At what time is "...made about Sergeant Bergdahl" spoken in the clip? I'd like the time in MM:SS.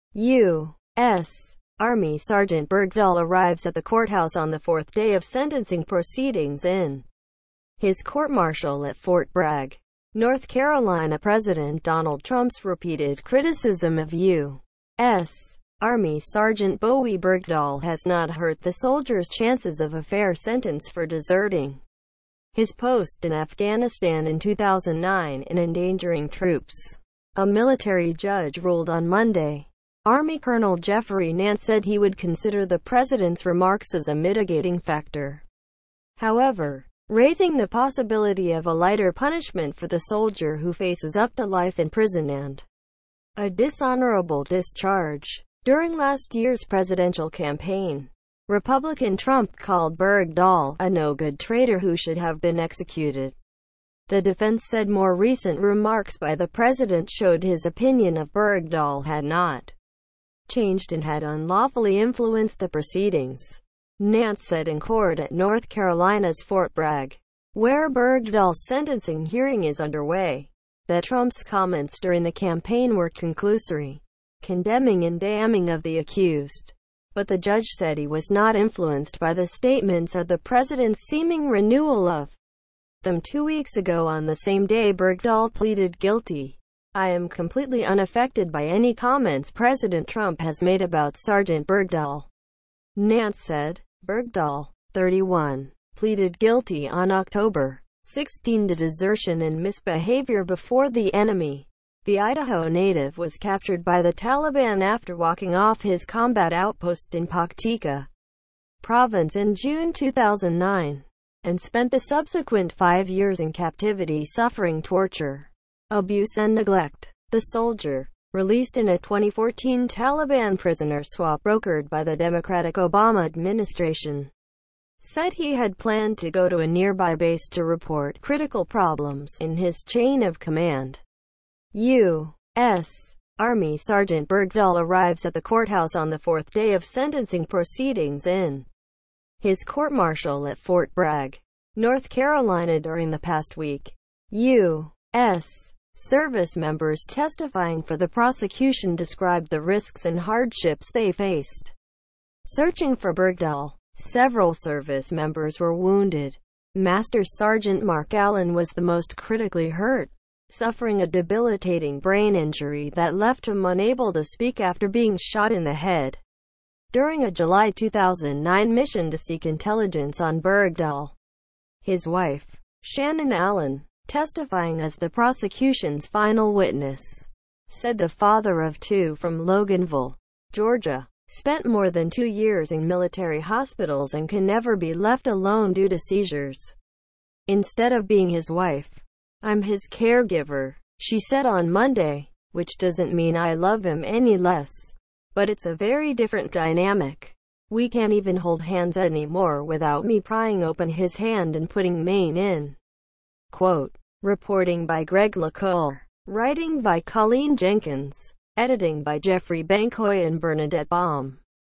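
01:30.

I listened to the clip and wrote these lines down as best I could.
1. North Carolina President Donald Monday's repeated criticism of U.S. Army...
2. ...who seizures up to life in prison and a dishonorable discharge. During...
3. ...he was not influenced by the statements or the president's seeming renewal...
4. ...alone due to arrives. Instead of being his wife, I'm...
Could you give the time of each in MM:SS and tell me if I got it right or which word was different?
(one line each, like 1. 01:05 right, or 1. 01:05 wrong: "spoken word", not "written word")
1. 00:10 wrong: "Trump", not "Monday"
2. 00:40 wrong: "faces", not "seizures"
3. 01:17 right
4. 03:05 wrong: "seizures", not "arrives".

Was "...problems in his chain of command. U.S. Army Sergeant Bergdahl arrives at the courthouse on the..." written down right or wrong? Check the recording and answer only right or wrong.
right.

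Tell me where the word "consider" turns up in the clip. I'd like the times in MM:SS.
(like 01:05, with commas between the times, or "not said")
00:32.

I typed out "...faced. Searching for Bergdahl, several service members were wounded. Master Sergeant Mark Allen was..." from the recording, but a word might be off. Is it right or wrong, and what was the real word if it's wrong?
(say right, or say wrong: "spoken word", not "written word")
right.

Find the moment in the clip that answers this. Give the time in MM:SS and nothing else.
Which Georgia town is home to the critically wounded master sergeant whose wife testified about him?
02:59.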